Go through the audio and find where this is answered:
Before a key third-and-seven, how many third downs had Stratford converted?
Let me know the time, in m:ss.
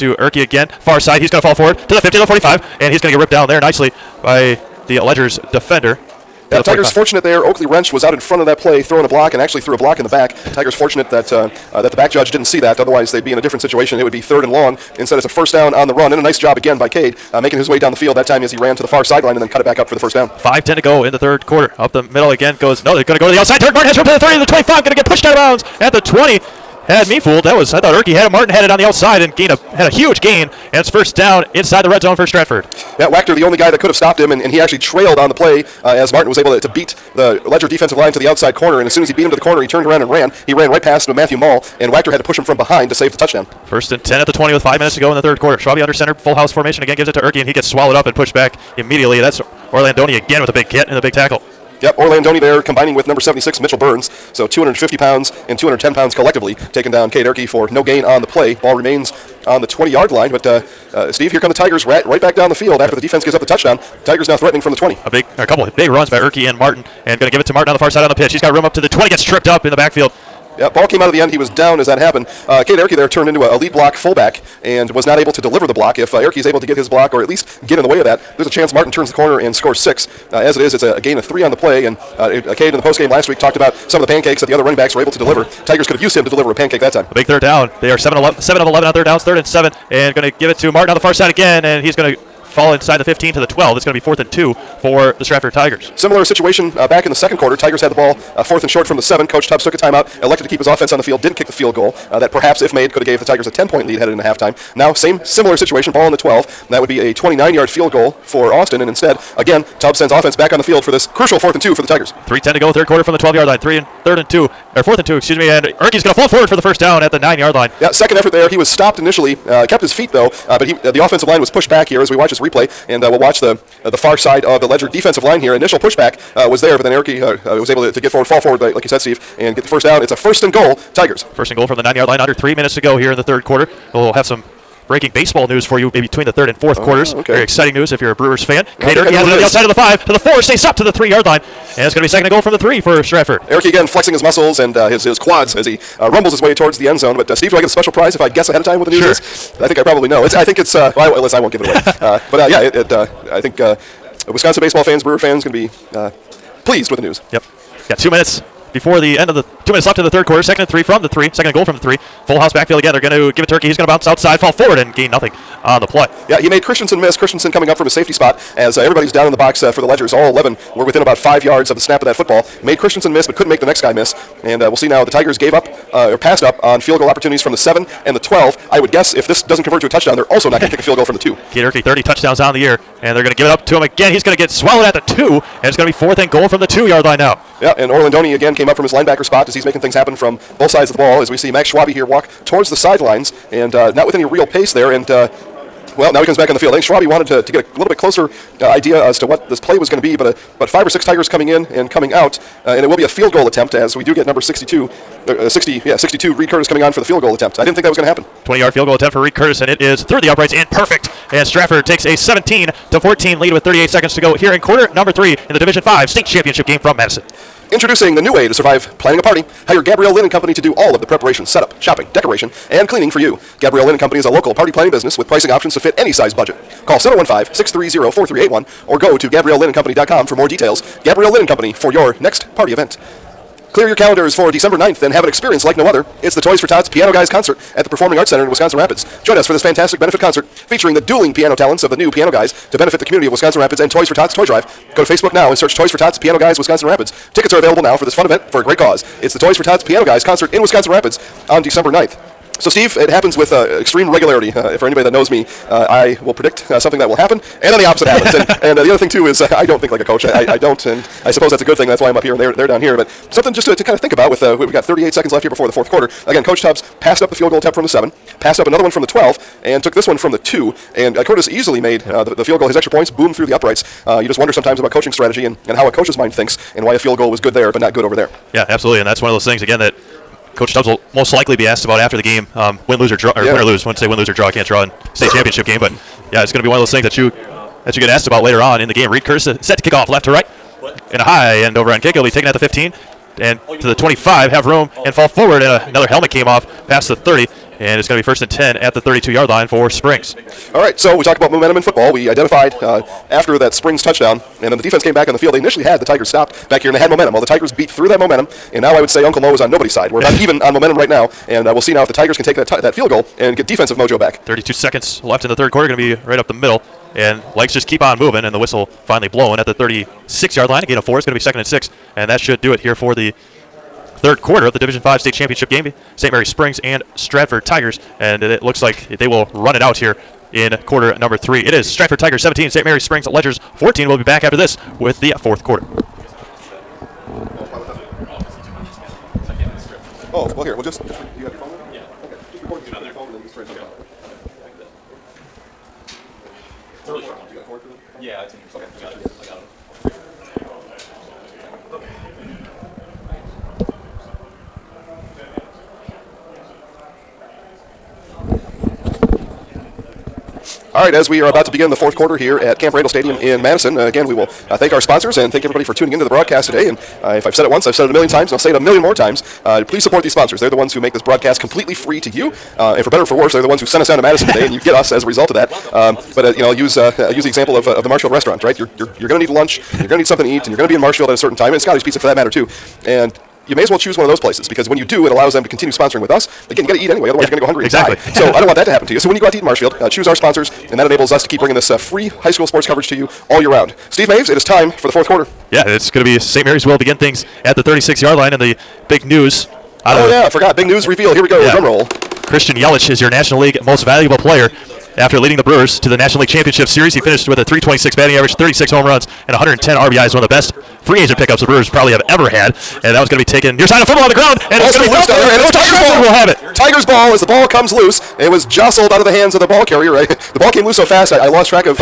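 1:28.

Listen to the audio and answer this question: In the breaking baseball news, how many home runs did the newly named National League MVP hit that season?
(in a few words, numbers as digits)
36.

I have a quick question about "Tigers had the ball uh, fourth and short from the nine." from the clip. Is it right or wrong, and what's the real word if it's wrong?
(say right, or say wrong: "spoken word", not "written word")
wrong: "seven", not "nine".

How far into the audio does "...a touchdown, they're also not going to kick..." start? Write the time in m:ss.
2:59.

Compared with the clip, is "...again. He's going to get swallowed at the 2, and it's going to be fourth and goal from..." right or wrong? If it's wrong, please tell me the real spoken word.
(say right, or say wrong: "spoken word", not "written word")
right.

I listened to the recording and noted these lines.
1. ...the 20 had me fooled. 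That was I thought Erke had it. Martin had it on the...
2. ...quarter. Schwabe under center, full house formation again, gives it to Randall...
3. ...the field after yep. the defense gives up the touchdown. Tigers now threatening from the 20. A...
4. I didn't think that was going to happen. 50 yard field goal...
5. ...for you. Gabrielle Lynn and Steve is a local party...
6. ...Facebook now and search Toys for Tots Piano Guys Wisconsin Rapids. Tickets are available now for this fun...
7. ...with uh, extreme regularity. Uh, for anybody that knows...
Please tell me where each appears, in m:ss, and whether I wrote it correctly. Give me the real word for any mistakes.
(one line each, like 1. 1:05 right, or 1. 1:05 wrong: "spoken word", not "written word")
1. 0:25 right
2. 0:45 wrong: "Erke", not "Randall"
3. 1:02 right
4. 3:27 wrong: "20", not "50"
5. 3:43 wrong: "Company", not "Steve"
6. 4:05 right
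7. 4:13 right.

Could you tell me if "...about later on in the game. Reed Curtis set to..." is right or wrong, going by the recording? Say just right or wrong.
right.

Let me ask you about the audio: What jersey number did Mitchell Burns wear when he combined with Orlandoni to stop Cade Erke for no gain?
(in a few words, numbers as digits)
76.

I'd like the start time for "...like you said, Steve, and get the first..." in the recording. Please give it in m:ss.
2:08.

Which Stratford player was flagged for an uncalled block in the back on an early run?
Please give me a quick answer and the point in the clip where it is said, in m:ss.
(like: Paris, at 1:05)
Oakley Wrench, at 0:07.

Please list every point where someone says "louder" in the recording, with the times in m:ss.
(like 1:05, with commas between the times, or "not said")
not said.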